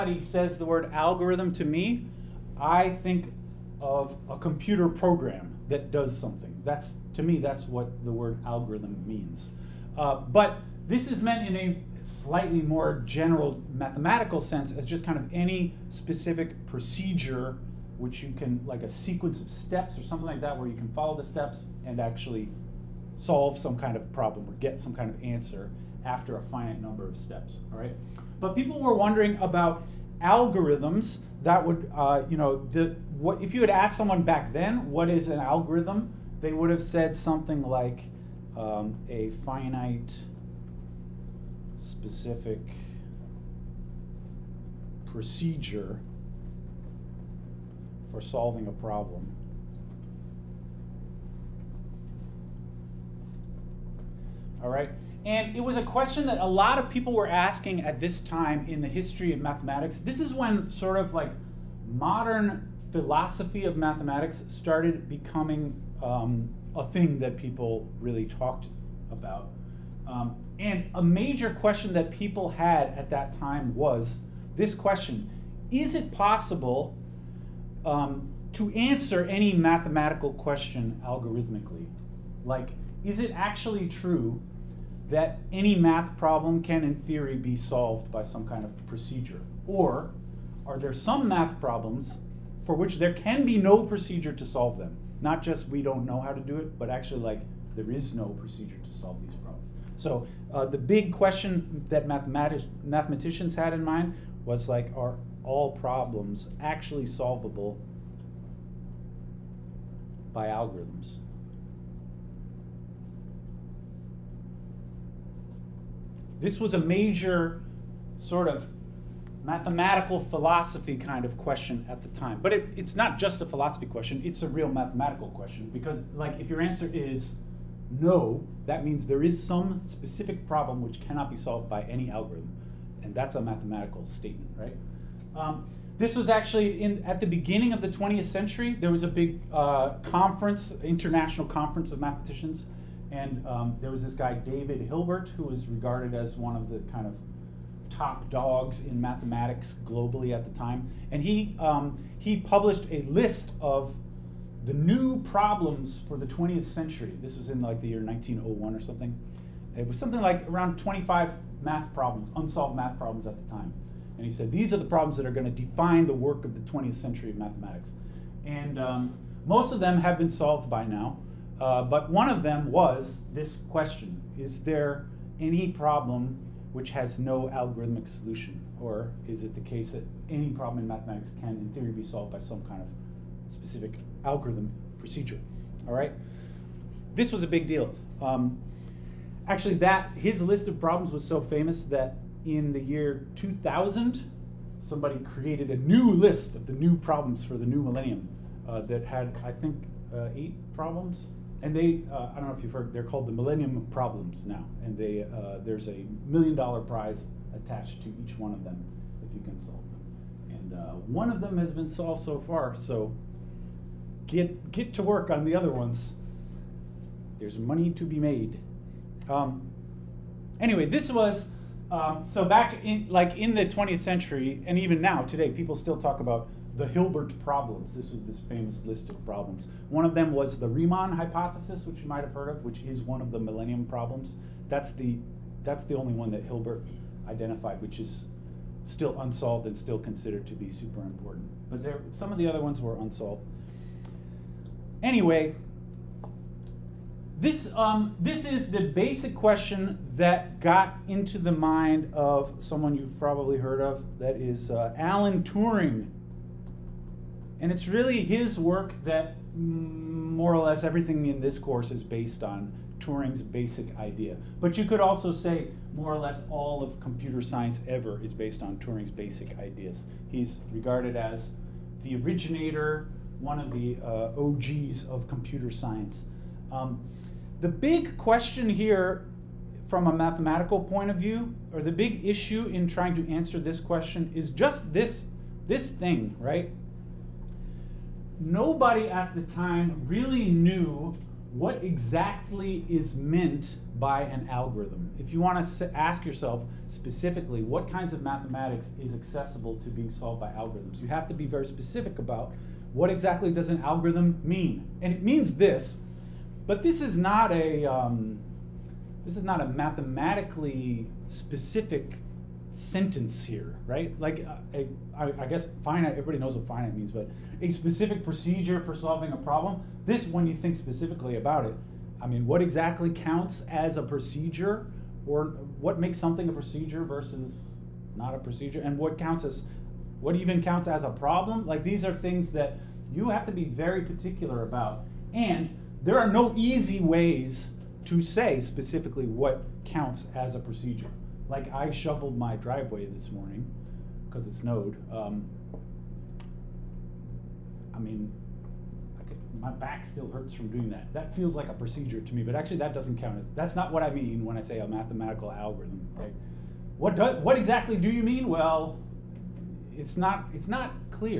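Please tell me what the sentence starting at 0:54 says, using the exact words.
All right, and it was a question that a lot of people were asking at this time in the history of mathematics.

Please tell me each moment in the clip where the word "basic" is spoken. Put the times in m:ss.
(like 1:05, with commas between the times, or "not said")
4:08, 4:23, 4:29.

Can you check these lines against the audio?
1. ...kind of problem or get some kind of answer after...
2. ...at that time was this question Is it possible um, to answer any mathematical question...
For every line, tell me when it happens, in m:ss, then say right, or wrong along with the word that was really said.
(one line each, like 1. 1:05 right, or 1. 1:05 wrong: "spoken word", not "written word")
1. 0:23 right
2. 1:12 right.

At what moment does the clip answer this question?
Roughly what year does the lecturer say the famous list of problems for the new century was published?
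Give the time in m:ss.
2:38.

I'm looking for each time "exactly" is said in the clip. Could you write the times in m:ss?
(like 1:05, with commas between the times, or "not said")
4:51, 5:03, 5:22, 5:57.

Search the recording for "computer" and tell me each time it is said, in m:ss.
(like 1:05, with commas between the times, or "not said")
0:04, 4:26, 4:35.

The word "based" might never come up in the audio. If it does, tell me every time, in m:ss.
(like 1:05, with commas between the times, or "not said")
4:22, 4:28.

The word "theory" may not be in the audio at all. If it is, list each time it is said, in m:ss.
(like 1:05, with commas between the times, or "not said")
1:26, 3:01.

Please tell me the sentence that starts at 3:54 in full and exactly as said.
That's the that's the only one that Hilbert identified, which is still unsolved and still considered to be super important.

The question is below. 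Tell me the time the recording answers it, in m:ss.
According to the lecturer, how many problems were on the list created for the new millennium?
3:20.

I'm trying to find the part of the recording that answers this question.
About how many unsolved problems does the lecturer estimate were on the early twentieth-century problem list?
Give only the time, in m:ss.
2:40.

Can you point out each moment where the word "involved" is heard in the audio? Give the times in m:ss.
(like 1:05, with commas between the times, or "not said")
not said.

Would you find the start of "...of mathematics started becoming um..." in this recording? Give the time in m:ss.
1:03.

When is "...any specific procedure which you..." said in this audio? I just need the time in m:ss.
0:15.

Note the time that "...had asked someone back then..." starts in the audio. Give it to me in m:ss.
0:33.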